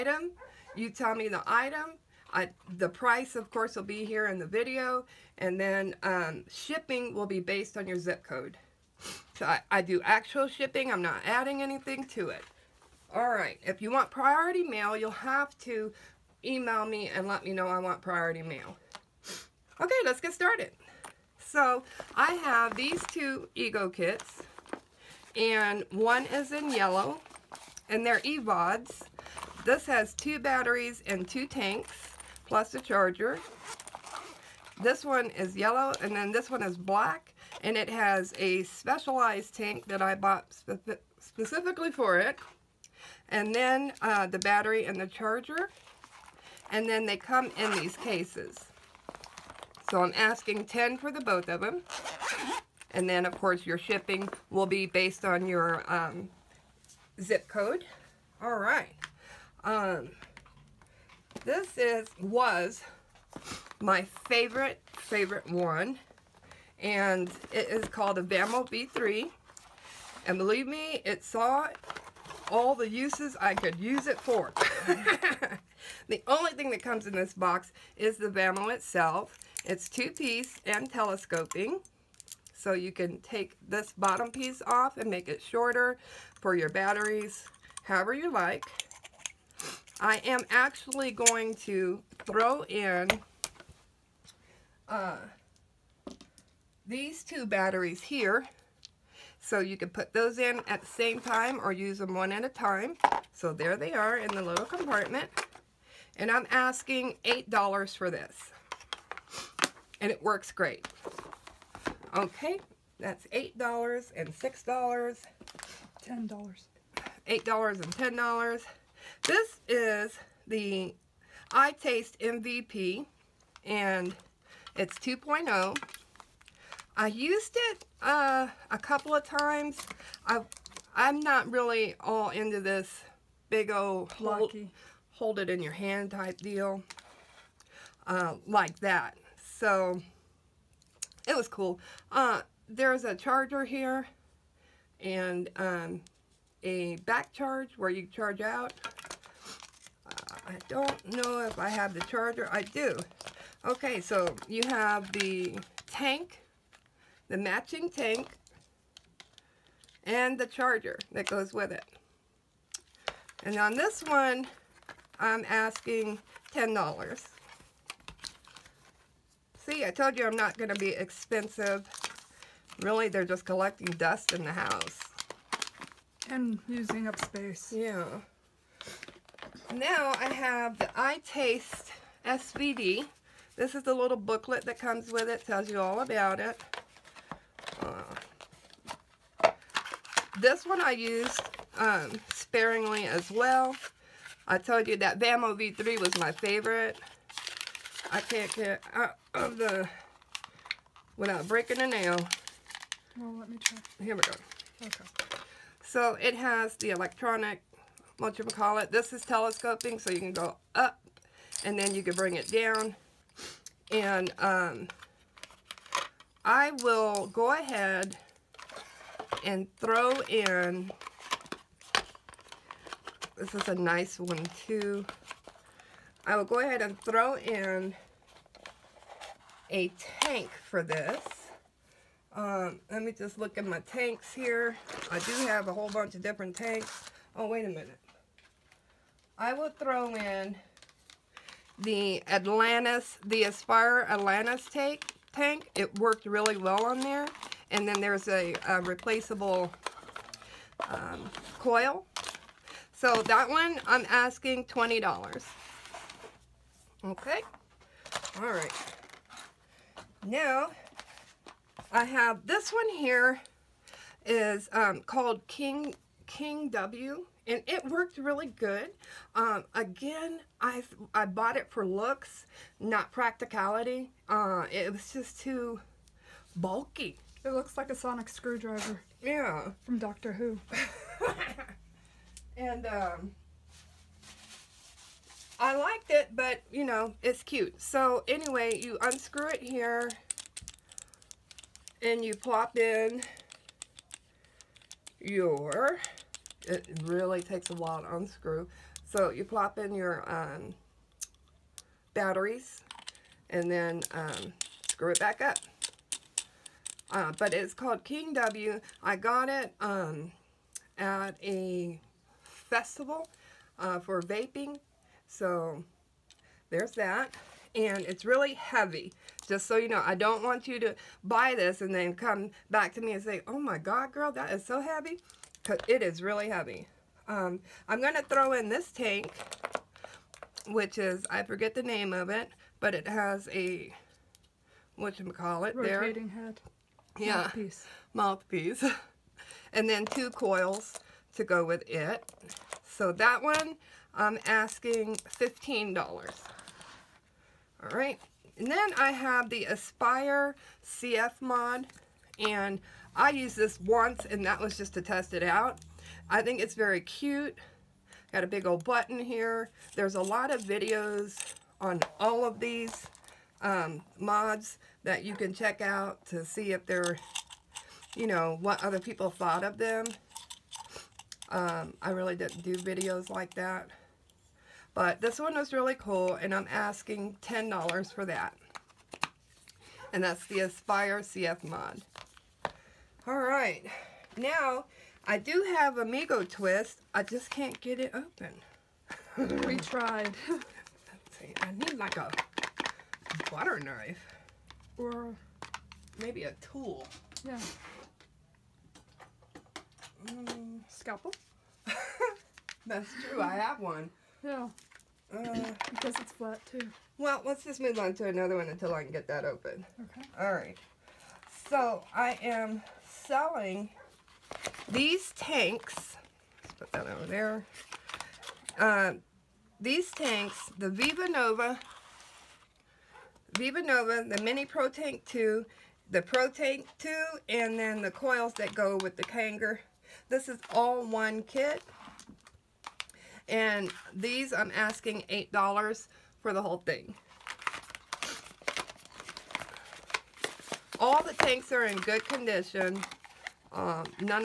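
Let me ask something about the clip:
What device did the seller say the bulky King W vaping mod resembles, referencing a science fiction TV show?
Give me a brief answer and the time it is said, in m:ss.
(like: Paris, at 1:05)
Sonic screwdriver, at 4:37.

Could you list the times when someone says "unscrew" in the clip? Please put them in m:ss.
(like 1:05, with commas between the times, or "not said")
4:49, 4:58.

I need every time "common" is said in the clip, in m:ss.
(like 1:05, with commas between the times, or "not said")
not said.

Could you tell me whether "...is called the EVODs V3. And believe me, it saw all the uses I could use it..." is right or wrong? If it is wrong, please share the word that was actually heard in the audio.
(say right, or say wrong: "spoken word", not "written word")
wrong: "Vamo", not "EVODs".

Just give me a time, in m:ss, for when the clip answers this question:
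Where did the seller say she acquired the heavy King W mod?
5:10.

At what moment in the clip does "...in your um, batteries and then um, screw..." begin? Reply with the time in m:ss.
4:59.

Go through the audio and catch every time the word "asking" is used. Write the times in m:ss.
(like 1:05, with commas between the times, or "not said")
0:50, 1:46, 2:45, 4:14, 5:44, 6:16, 7:14.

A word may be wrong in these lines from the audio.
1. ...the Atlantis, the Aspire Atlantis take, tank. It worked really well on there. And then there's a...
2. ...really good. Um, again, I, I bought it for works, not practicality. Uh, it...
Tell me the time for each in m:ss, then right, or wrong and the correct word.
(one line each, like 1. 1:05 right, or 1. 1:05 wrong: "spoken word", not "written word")
1. 4:01 right
2. 4:28 wrong: "looks", not "works".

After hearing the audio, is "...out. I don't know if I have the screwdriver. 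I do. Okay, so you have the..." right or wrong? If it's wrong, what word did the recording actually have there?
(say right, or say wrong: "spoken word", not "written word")
wrong: "charger", not "screwdriver".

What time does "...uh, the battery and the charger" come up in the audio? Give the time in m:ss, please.
0:44.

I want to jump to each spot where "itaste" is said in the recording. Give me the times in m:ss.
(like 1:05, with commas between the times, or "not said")
2:01, 3:00.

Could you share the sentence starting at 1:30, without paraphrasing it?
I am actually going to throw in uh, these two batteries here.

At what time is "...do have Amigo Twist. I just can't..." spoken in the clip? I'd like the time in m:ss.
6:25.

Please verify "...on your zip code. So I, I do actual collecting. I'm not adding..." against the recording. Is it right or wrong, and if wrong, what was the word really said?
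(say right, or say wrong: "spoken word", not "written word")
wrong: "shipping", not "collecting".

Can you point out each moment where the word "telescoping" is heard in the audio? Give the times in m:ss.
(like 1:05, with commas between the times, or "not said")
1:20, 3:29.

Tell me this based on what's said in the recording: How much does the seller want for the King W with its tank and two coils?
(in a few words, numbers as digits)
$15.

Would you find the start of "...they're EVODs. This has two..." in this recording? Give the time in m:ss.
0:28.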